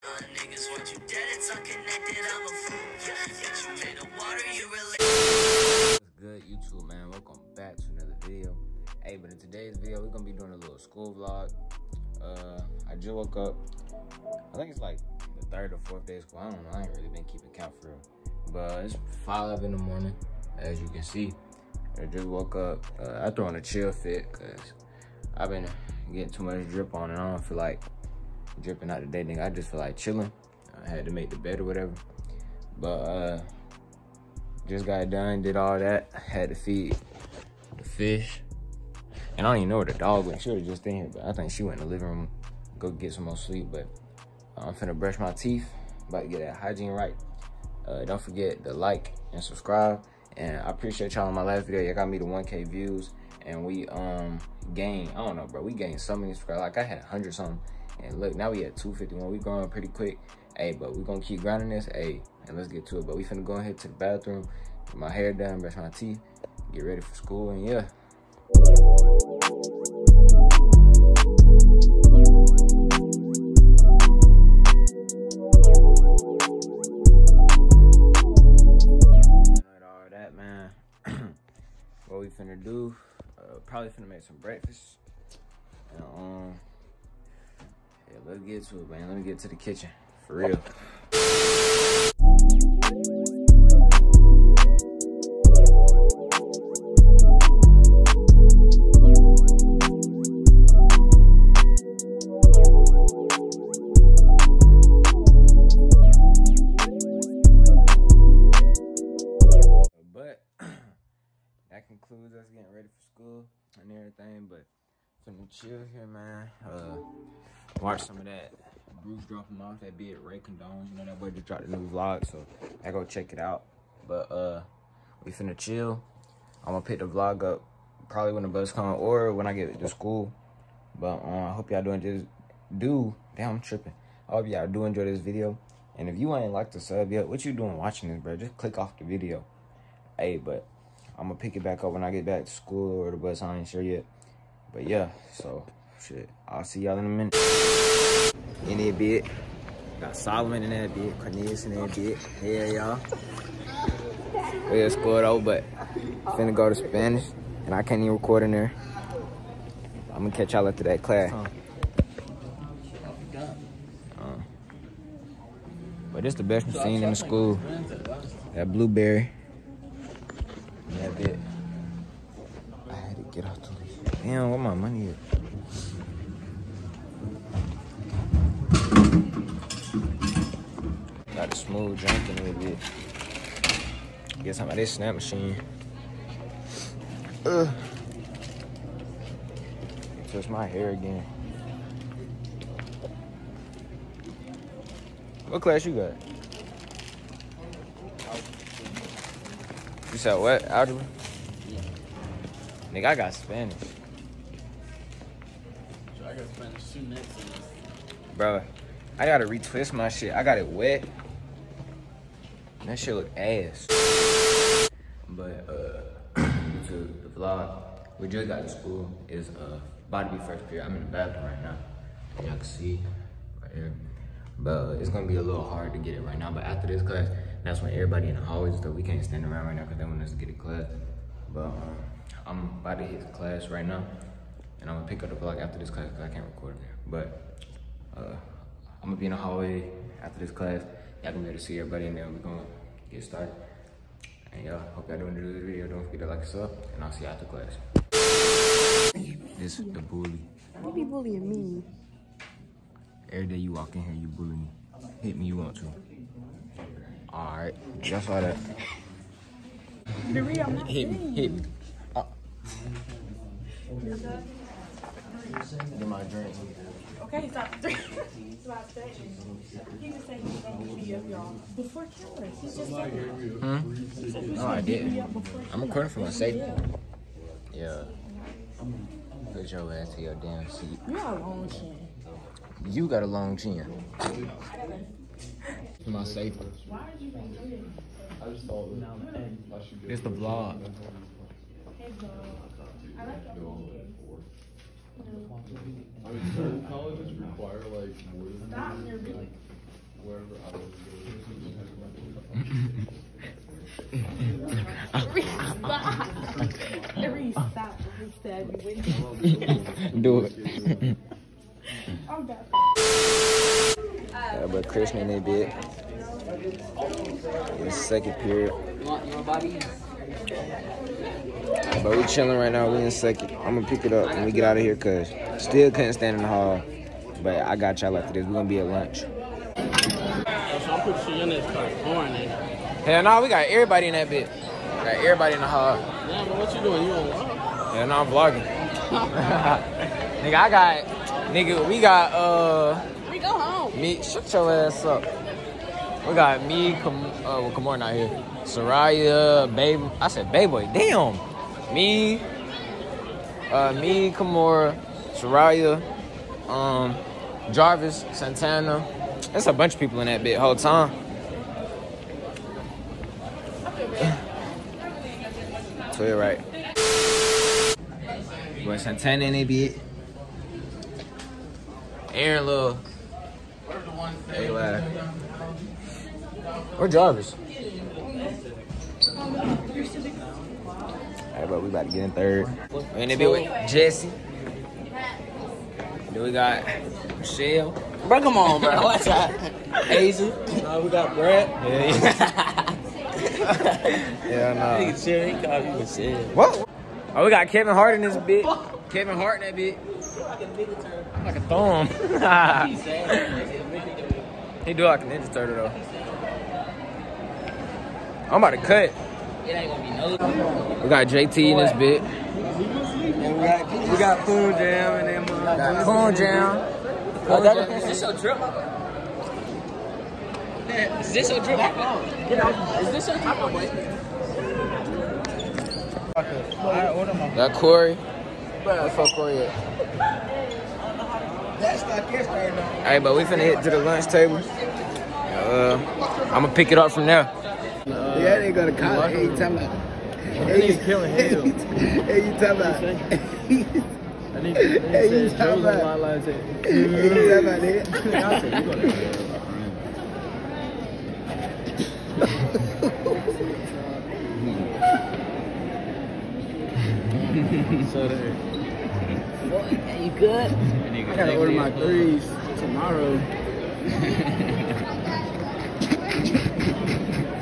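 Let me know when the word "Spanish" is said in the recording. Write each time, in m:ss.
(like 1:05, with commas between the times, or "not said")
2:36, 3:23.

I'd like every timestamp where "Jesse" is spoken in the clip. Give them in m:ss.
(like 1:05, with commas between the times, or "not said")
6:23.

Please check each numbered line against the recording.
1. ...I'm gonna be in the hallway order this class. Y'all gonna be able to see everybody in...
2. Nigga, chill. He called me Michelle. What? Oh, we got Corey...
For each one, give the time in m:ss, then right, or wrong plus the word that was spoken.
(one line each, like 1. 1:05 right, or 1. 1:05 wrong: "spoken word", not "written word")
1. 3:59 wrong: "after", not "order"
2. 6:35 wrong: "Kevin", not "Corey".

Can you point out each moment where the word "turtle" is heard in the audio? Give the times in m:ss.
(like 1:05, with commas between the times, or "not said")
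6:45.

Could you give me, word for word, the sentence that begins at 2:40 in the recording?
I'm gonna catch y'all after that class.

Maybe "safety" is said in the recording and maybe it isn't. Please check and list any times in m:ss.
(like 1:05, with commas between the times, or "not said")
4:36, 4:46.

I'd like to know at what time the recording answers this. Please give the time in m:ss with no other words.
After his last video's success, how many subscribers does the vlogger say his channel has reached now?
0:58.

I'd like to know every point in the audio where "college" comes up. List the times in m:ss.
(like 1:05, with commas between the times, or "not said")
7:18.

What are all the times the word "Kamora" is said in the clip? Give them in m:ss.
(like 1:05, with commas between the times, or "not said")
5:47, 5:54.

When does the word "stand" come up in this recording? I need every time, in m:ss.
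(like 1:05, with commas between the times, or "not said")
3:49, 5:26.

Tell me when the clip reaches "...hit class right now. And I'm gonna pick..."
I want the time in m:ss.
3:53.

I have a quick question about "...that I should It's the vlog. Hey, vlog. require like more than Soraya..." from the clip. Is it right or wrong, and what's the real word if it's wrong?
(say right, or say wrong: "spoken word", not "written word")
wrong: "Stop", not "Soraya".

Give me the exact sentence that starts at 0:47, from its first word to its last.
Uh, don't forget to like and subscribe.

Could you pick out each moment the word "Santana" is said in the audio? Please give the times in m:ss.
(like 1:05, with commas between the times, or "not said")
5:58, 6:08.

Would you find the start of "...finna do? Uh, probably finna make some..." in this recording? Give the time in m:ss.
1:22.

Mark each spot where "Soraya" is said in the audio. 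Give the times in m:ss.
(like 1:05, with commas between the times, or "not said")
5:48, 5:55.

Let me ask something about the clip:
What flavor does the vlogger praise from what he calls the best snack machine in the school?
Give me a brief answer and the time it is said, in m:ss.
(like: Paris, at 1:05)
Blueberry, at 2:48.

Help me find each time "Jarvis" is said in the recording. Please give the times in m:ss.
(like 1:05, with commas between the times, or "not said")
5:57, 6:17.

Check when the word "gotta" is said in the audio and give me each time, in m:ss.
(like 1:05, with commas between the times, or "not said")
3:29, 7:41.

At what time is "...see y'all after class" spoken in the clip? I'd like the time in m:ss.
4:07.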